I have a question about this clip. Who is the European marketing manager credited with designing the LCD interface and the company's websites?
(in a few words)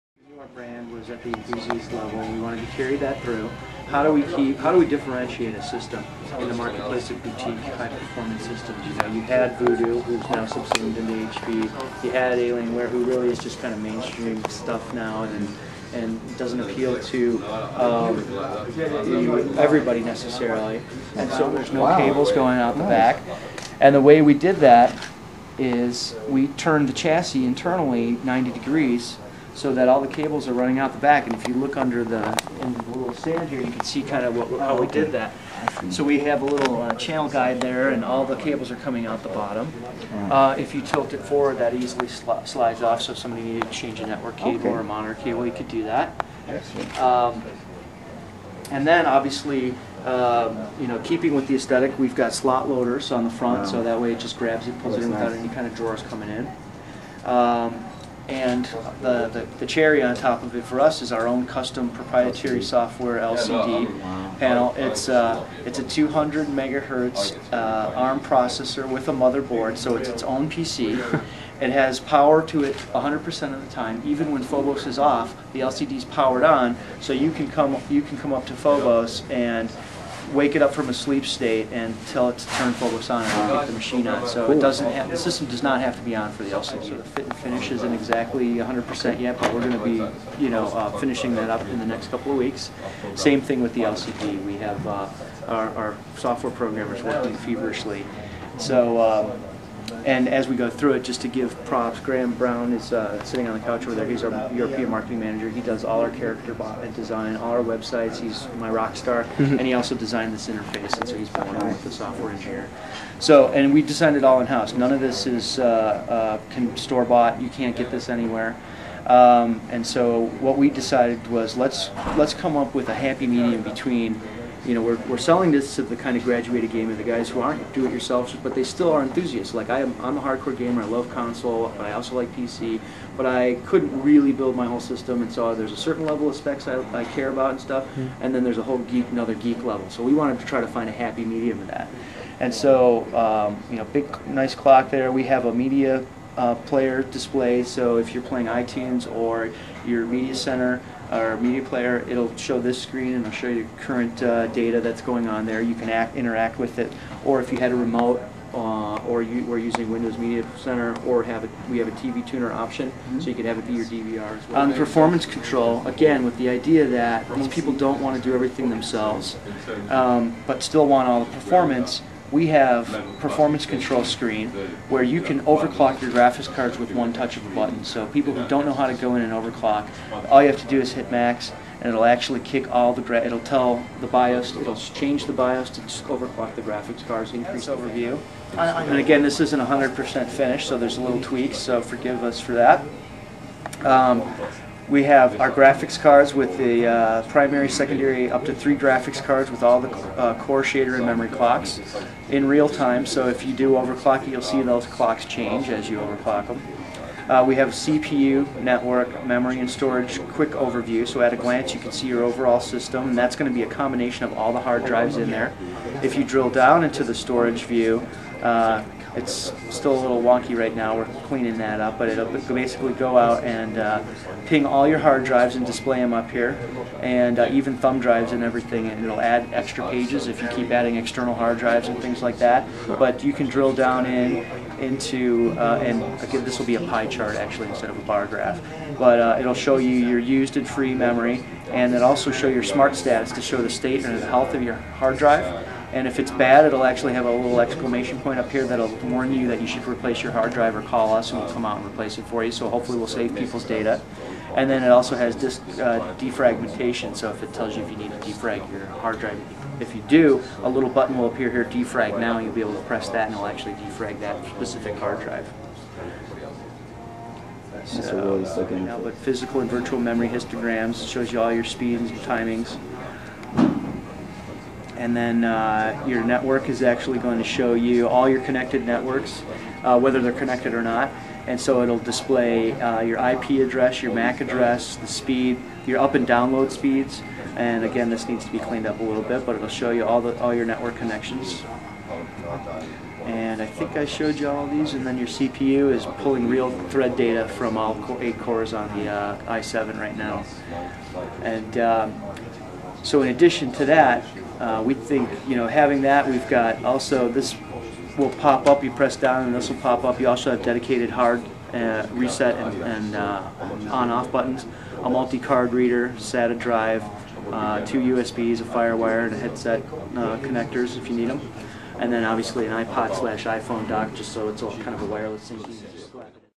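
Graham Brown.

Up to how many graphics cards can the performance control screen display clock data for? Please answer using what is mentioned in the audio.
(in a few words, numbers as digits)
3.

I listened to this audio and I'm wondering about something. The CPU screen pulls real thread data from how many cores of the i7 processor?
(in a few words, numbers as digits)
8.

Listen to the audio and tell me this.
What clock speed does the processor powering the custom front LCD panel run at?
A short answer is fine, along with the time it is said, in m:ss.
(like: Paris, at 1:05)
200 megahertz, at 1:05.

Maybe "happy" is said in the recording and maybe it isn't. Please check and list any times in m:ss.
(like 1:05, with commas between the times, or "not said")
2:02, 2:20.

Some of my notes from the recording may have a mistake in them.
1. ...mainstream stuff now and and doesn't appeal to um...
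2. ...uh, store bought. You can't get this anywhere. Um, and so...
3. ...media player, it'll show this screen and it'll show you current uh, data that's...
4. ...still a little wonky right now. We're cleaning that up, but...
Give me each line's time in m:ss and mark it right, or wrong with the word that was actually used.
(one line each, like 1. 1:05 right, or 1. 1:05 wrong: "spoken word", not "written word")
1. 0:13 right
2. 1:56 right
3. 2:31 right
4. 3:39 right.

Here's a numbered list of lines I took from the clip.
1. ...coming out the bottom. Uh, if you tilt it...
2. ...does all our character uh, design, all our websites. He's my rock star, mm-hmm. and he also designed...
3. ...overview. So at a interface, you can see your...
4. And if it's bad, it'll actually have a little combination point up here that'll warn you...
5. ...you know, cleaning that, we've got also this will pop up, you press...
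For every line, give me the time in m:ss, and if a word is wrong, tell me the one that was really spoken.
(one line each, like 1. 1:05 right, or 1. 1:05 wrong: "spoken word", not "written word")
1. 0:38 right
2. 1:45 right
3. 3:30 wrong: "glance", not "interface"
4. 4:05 wrong: "exclamation", not "combination"
5. 5:05 wrong: "having", not "cleaning".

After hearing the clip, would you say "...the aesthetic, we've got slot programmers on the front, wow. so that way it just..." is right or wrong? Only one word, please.
wrong.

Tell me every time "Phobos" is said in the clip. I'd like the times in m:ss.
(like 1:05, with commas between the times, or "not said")
1:14, 1:18, 1:22.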